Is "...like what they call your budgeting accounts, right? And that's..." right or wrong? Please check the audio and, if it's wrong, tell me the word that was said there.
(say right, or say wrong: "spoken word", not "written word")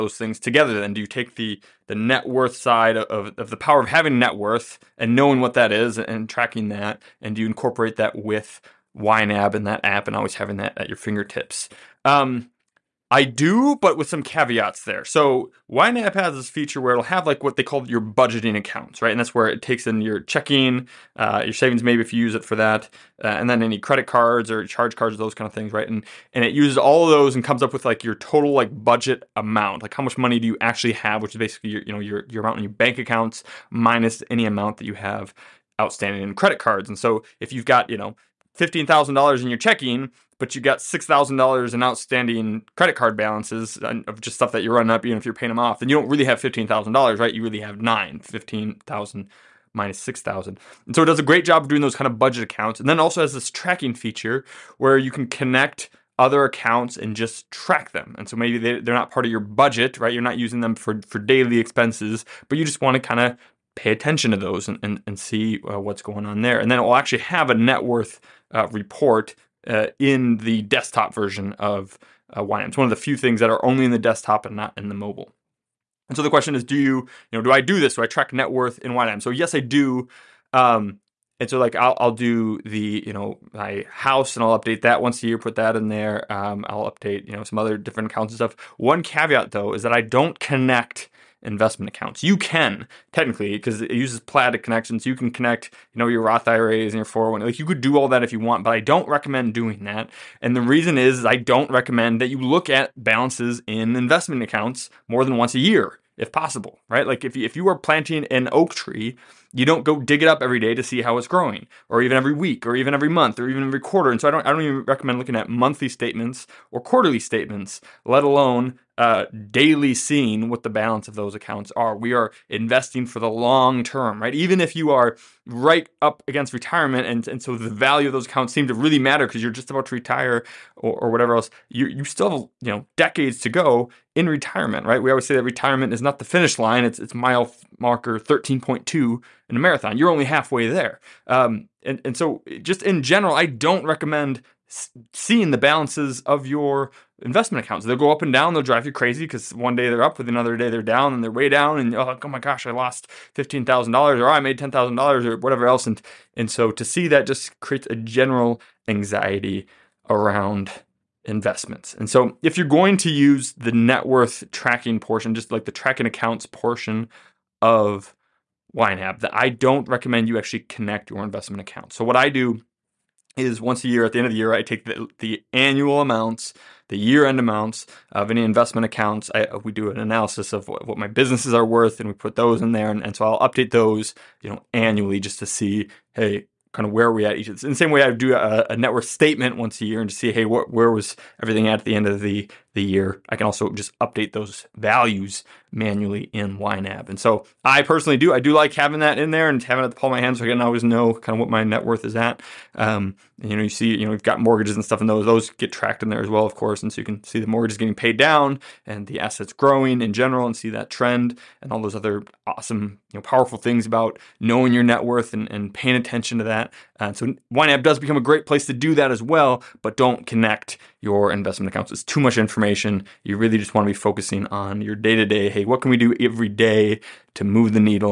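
right.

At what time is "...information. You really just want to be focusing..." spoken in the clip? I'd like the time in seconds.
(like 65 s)
222 s.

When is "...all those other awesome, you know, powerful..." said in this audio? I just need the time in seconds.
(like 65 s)
211 s.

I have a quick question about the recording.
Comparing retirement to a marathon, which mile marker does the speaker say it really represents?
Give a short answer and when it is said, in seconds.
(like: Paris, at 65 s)
13.2, at 138 s.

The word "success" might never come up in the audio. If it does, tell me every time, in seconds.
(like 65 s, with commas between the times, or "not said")
not said.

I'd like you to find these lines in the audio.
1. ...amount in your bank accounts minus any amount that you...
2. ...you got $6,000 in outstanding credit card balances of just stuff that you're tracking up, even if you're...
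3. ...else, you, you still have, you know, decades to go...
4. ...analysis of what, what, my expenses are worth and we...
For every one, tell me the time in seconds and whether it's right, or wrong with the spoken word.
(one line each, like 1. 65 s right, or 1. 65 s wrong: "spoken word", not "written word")
1. 32 s right
2. 40 s wrong: "running", not "tracking"
3. 131 s right
4. 179 s wrong: "businesses", not "expenses".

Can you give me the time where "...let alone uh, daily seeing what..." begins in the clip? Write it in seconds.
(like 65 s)
118 s.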